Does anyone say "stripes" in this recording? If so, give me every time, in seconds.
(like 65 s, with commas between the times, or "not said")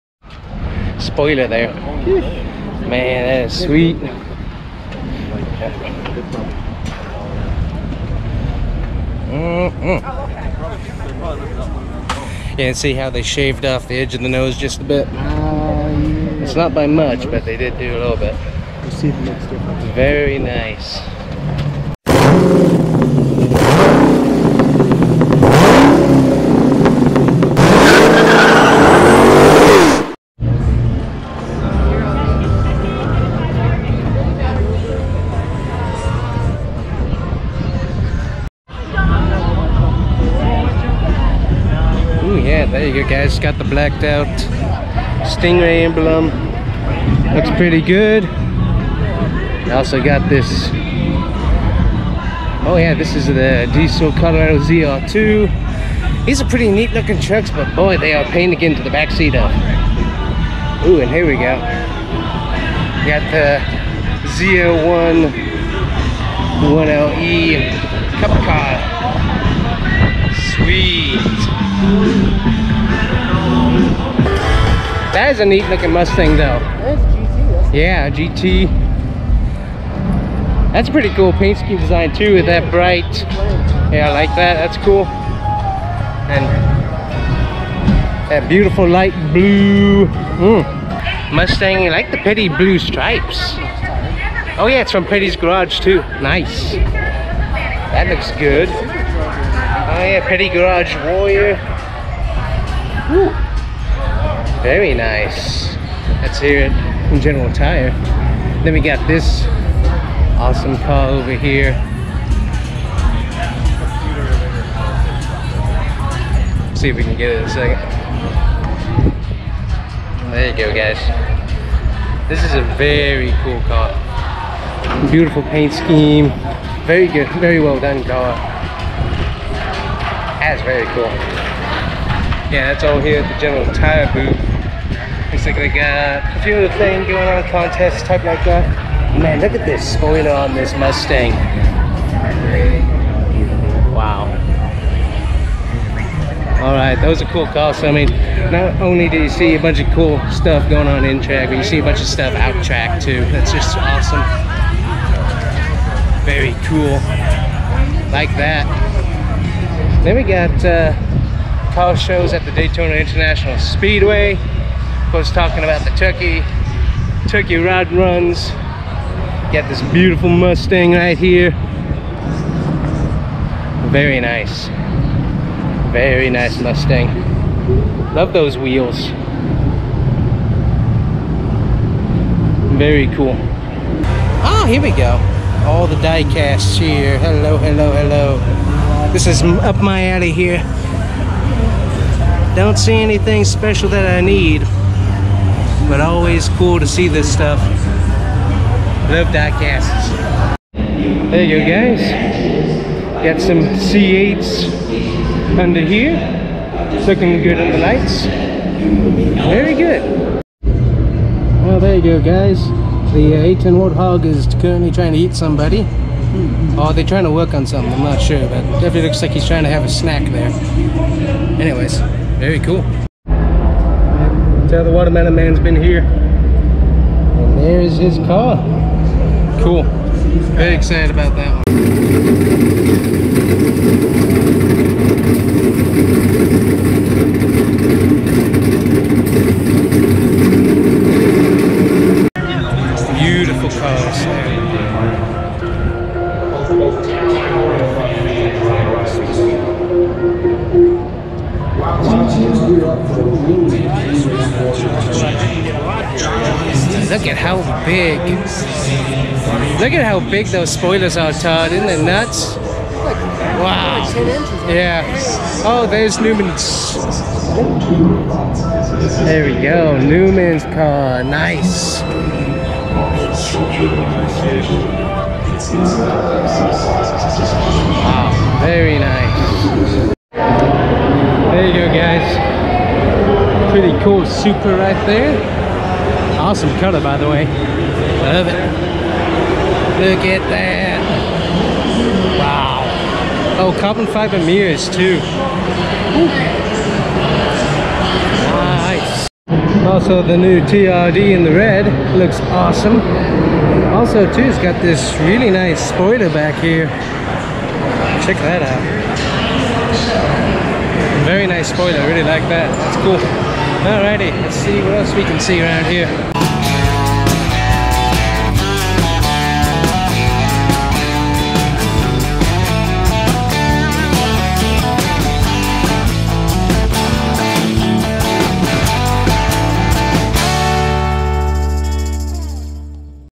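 92 s.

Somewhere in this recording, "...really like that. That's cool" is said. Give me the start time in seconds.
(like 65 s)
312 s.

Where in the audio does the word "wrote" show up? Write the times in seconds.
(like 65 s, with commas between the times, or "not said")
not said.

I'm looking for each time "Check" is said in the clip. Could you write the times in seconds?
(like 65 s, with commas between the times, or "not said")
308 s.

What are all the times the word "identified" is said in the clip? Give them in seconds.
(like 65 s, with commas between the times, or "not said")
not said.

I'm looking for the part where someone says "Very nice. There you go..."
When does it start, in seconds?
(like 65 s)
278 s.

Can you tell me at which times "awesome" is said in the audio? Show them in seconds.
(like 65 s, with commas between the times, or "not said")
110 s, 153 s, 286 s, 302 s.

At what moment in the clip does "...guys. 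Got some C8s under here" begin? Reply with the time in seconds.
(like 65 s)
201 s.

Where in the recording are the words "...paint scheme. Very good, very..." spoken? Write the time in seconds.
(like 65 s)
125 s.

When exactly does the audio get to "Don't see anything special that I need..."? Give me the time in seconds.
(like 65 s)
192 s.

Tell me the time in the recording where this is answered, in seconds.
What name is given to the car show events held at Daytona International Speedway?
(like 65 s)
167 s.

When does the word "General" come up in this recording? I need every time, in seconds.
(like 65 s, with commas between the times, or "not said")
107 s, 133 s.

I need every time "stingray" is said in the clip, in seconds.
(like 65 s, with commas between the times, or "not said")
45 s.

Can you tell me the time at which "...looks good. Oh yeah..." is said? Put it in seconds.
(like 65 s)
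98 s.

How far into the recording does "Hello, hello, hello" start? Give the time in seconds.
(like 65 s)
187 s.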